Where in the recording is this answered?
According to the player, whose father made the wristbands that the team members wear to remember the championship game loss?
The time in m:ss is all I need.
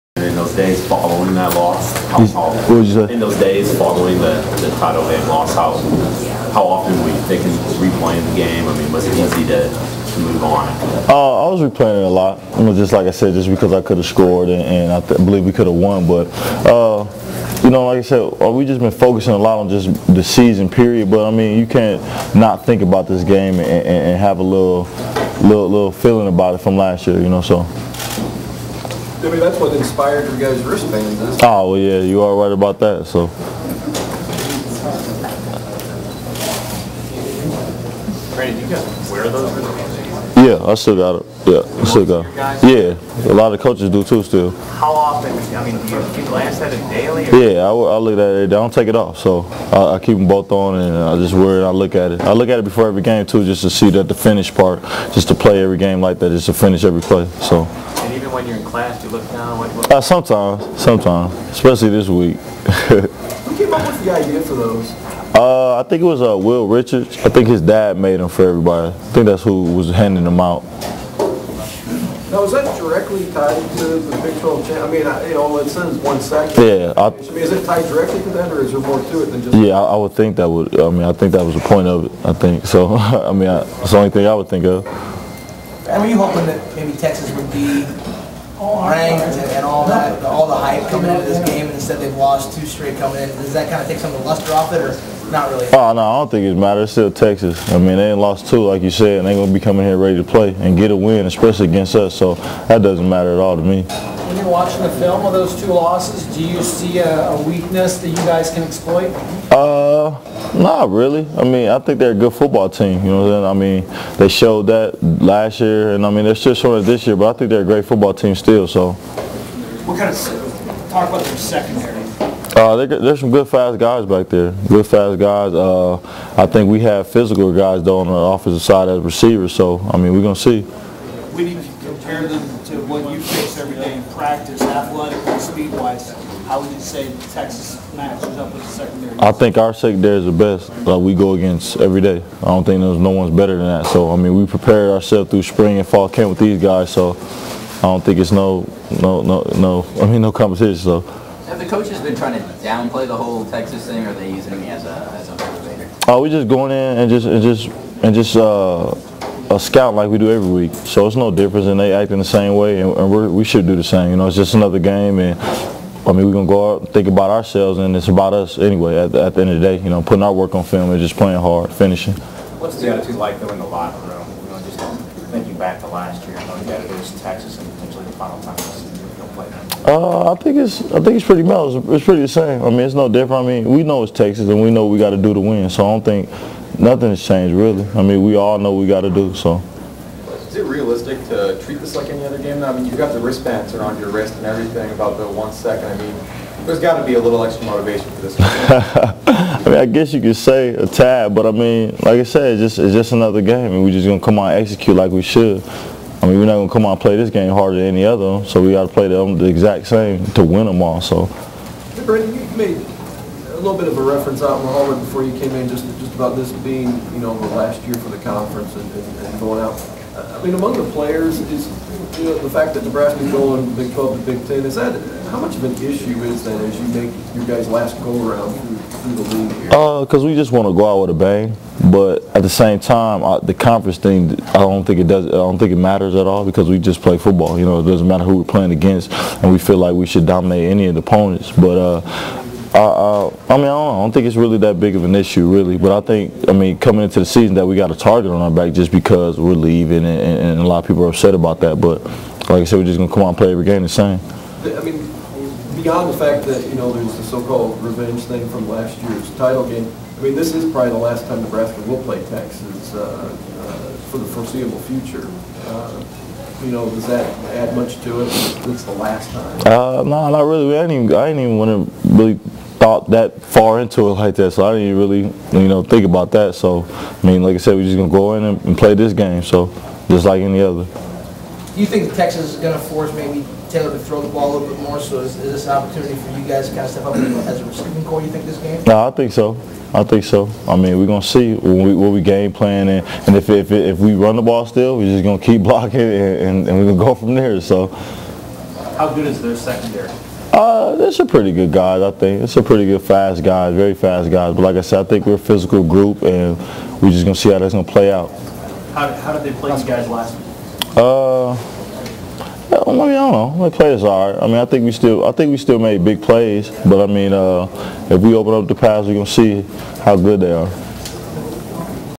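1:06.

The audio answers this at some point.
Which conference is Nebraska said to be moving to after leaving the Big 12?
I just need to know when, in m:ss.
3:44.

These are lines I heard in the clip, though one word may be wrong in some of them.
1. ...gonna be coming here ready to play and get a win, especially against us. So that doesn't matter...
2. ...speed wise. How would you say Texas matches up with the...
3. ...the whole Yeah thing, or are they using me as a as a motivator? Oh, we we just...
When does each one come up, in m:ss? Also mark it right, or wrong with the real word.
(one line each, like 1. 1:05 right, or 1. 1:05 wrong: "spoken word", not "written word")
1. 1:39 right
2. 2:15 right
3. 2:33 wrong: "Texas", not "Yeah".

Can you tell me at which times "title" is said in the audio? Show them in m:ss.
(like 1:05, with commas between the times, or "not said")
0:04, 4:19.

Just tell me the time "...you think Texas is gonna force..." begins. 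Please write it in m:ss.
4:41.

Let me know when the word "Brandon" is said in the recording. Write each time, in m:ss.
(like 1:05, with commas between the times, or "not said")
0:38.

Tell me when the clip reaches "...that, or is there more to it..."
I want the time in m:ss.
1:18.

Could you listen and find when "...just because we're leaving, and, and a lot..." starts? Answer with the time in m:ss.
4:08.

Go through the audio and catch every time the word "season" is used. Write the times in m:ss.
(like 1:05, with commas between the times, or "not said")
0:20, 4:07.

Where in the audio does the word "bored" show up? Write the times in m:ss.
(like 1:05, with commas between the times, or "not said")
not said.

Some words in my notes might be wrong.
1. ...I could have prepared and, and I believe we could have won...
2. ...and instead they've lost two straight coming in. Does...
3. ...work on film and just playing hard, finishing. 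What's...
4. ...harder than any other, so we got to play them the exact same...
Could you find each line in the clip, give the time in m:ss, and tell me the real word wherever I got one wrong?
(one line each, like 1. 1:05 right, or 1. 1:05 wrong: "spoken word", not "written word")
1. 0:13 wrong: "scored", not "prepared"
2. 1:31 right
3. 2:50 right
4. 3:27 right.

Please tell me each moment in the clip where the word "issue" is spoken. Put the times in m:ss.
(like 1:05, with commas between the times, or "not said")
3:45, 4:05.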